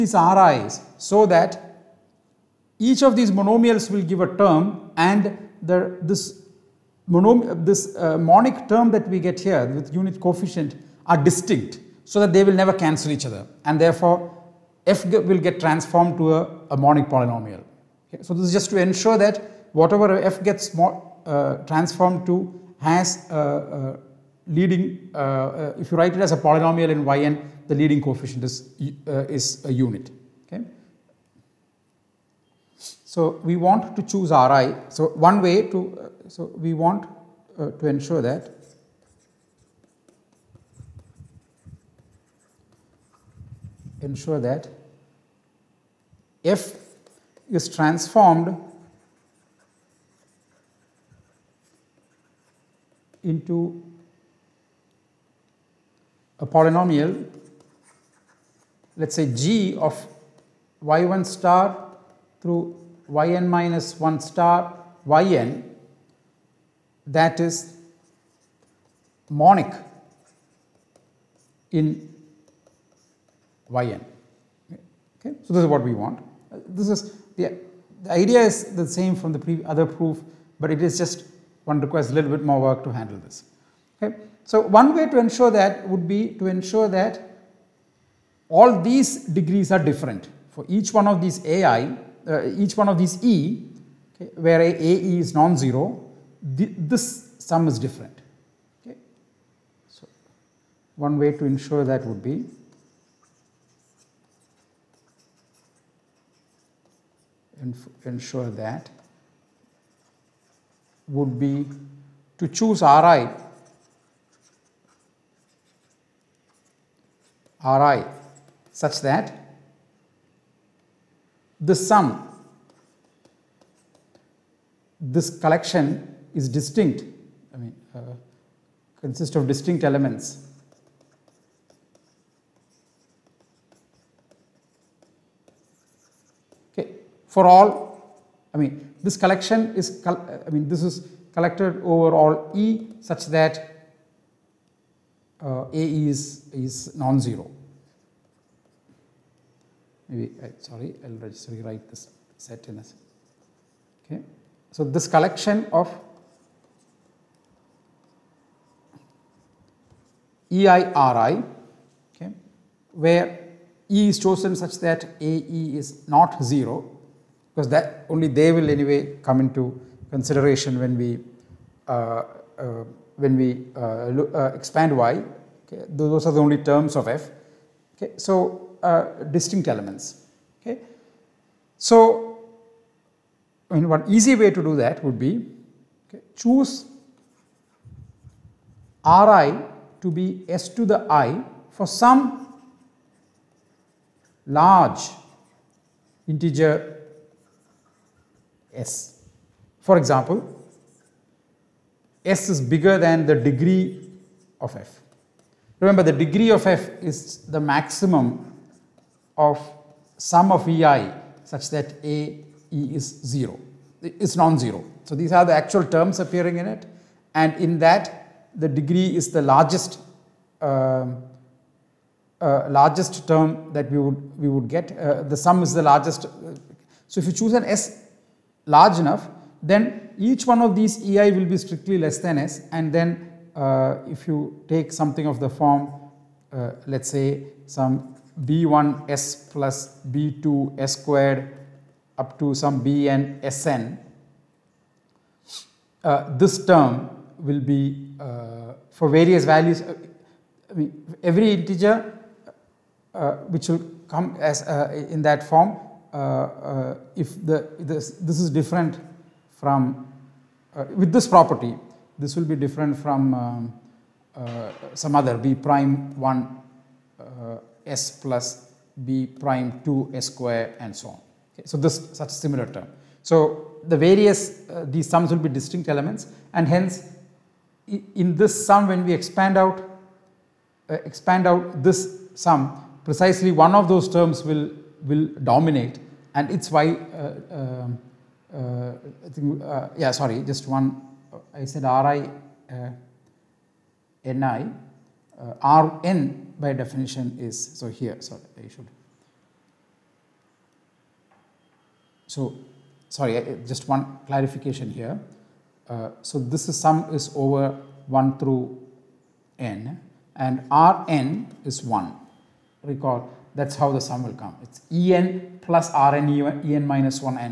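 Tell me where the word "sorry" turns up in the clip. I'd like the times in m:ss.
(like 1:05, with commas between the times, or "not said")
2:30, 4:50, 4:58, 5:03.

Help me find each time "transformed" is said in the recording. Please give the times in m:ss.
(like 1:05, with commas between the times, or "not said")
0:15, 0:21, 0:47.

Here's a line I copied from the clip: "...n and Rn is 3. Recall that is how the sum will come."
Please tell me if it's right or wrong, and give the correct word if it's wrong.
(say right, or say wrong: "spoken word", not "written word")
wrong: "1", not "3".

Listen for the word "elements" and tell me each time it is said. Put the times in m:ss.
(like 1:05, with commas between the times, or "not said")
2:09, 2:59, 4:35.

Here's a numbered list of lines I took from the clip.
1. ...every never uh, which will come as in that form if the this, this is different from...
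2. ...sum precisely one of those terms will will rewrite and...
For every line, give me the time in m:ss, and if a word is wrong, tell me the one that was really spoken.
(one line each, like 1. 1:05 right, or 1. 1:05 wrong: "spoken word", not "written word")
1. 4:11 wrong: "integer", not "never"
2. 4:42 wrong: "dominate", not "rewrite".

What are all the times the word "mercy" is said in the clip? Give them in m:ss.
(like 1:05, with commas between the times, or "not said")
not said.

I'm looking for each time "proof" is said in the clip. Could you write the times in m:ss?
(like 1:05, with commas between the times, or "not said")
1:19.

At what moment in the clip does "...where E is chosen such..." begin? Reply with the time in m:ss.
2:42.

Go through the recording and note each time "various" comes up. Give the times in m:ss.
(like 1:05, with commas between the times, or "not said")
4:09, 4:34.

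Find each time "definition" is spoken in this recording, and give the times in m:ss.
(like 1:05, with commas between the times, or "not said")
4:56.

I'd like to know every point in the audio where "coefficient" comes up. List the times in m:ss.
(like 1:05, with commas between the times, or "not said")
0:10, 0:28.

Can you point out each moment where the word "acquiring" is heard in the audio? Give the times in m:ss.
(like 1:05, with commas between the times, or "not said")
not said.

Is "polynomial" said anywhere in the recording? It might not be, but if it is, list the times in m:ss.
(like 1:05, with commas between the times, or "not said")
0:17, 0:26, 0:56.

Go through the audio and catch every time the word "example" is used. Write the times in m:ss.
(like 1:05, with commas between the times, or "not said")
3:19.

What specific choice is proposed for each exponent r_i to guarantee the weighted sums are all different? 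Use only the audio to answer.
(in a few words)
s to the i.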